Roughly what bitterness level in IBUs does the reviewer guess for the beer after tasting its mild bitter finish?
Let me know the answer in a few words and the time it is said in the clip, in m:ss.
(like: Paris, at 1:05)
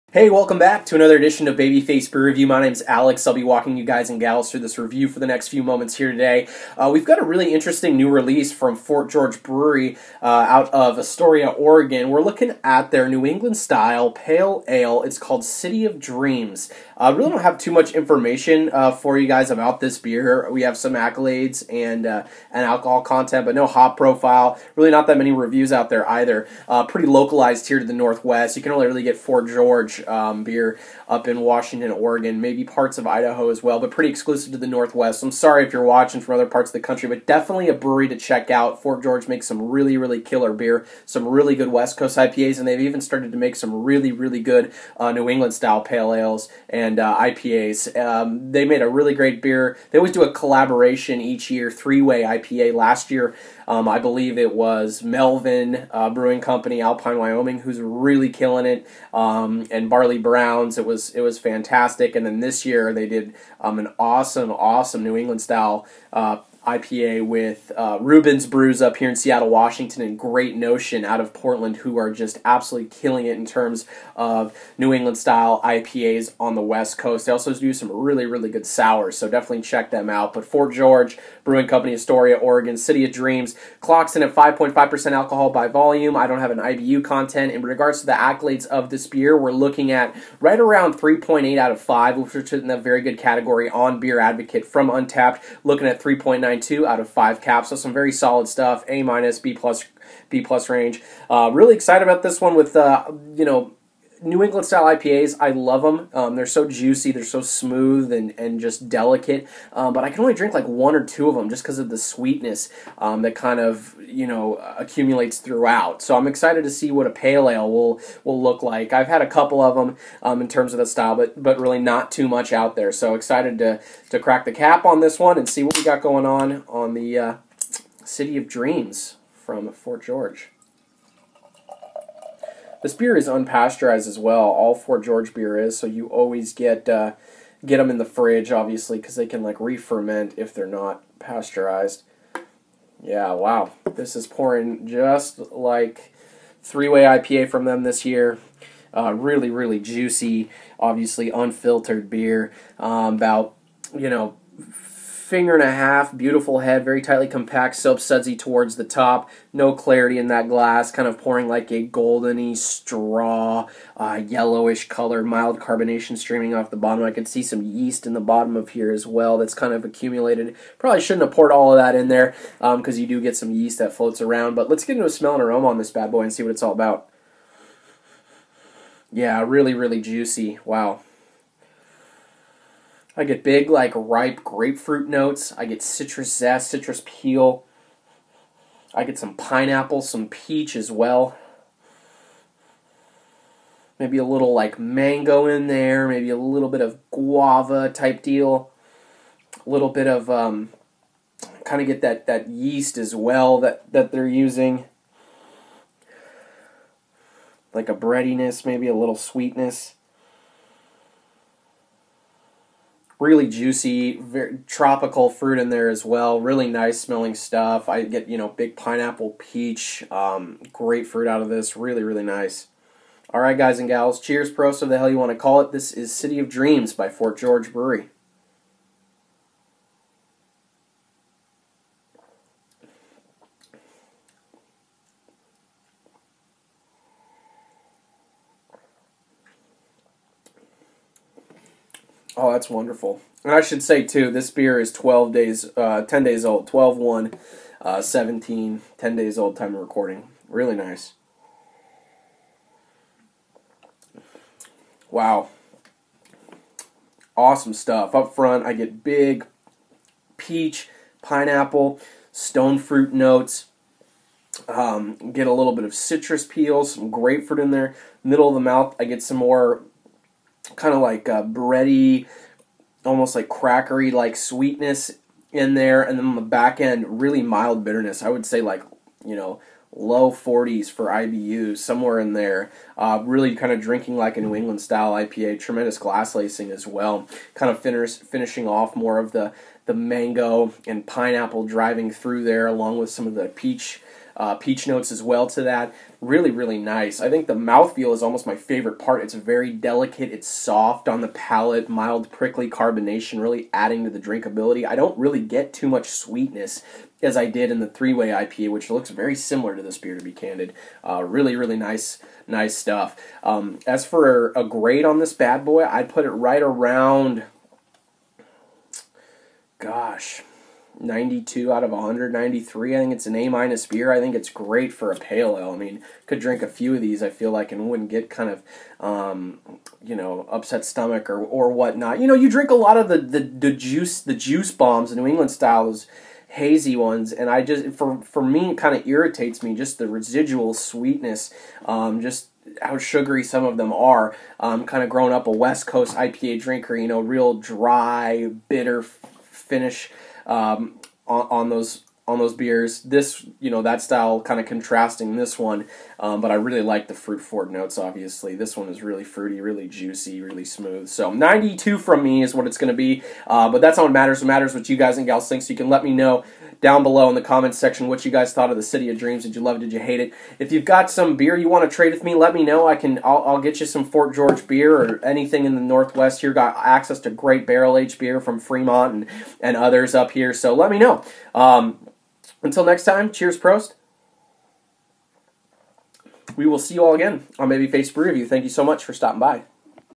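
low 40s, at 4:39.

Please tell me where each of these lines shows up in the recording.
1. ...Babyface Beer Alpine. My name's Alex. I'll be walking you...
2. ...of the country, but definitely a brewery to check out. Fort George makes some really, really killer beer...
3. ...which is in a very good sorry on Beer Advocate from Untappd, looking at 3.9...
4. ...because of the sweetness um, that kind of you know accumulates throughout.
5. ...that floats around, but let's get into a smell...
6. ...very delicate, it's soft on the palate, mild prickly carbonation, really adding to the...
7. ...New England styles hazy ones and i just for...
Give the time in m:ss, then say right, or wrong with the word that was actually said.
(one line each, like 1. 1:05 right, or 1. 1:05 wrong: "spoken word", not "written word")
1. 0:01 wrong: "Review", not "Alpine"
2. 0:36 right
3. 1:32 wrong: "category", not "sorry"
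4. 1:51 right
5. 2:53 right
6. 4:59 right
7. 5:35 right.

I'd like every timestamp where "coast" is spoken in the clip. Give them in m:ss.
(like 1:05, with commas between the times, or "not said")
0:41, 1:16, 5:45.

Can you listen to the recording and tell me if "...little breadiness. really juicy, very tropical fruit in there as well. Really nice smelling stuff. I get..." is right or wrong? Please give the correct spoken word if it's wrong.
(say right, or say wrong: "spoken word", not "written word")
wrong: "sweetness", not "breadiness".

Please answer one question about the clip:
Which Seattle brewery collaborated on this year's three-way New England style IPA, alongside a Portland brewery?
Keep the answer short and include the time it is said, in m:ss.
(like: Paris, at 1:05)
Reuben's Brews, at 1:07.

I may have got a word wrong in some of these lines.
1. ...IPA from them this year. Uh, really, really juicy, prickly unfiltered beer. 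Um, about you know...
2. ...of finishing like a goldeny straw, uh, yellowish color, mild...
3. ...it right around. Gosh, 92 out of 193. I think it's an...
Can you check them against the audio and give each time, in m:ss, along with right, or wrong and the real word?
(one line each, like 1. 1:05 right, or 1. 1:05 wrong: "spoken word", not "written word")
1. 2:27 wrong: "obviously", not "prickly"
2. 2:41 wrong: "pouring", not "finishing"
3. 5:16 right.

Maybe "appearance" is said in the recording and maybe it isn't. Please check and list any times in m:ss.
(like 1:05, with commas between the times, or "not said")
not said.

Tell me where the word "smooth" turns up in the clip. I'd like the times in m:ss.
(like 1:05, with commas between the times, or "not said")
1:47, 6:00.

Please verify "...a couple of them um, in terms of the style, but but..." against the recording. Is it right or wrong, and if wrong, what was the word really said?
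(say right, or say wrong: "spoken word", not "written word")
right.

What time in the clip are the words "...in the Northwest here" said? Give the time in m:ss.
6:15.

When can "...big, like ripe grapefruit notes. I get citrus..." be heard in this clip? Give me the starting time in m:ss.
3:03.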